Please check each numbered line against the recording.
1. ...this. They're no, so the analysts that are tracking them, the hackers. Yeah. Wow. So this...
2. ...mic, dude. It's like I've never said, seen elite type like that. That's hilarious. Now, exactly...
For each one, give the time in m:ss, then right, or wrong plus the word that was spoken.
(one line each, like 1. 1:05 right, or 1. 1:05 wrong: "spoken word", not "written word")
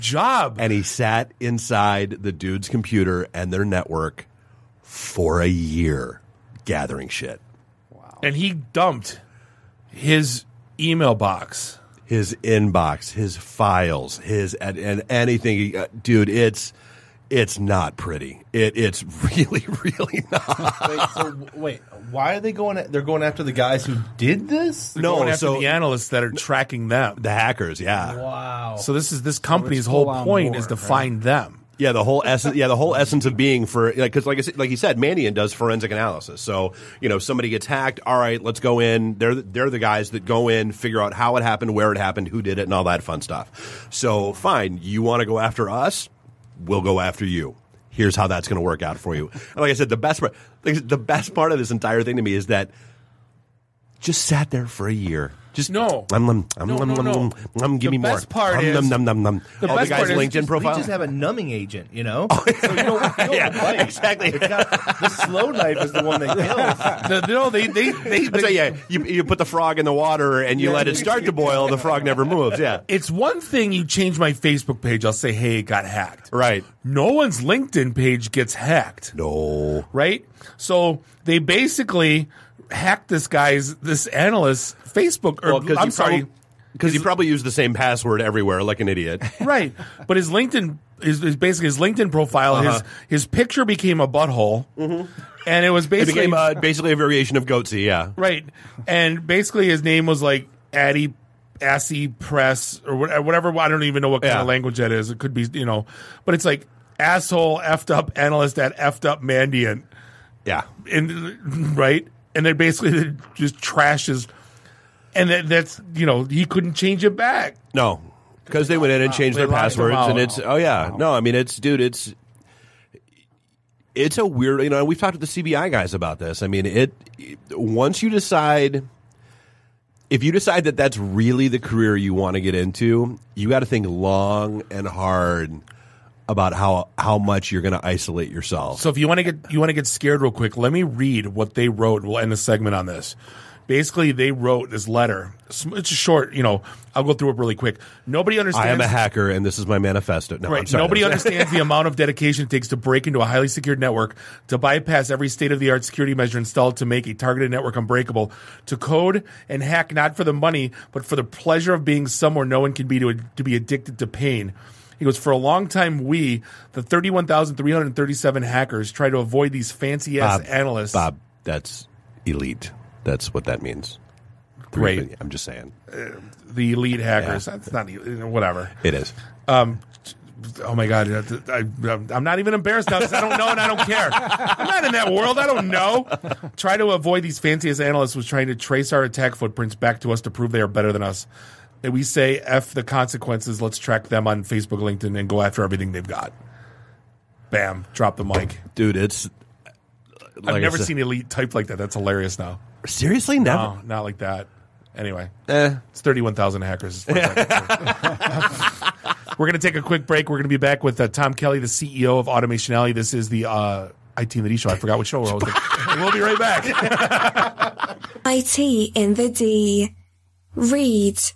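1. 0:24 right
2. 3:18 wrong: "seriously", not "exactly".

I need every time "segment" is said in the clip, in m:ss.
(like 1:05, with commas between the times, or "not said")
2:22.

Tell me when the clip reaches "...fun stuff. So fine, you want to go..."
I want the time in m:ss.
0:43.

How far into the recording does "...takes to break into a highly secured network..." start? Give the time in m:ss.
2:32.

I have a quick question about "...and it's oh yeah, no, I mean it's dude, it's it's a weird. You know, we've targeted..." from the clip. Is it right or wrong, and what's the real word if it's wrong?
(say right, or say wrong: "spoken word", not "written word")
wrong: "talked", not "targeted".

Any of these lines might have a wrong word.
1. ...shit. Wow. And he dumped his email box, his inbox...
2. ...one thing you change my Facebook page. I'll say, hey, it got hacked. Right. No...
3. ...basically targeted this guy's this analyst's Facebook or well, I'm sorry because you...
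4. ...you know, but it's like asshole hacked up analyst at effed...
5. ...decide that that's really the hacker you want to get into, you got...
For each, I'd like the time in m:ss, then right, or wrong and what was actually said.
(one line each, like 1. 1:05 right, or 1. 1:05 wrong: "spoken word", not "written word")
1. 0:07 right
2. 1:13 right
3. 1:21 wrong: "hacked", not "targeted"
4. 1:45 wrong: "effed", not "hacked"
5. 2:10 wrong: "career", not "hacker".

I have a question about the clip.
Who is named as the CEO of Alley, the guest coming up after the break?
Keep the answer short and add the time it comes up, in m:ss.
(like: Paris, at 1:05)
Tom Kelly, at 3:31.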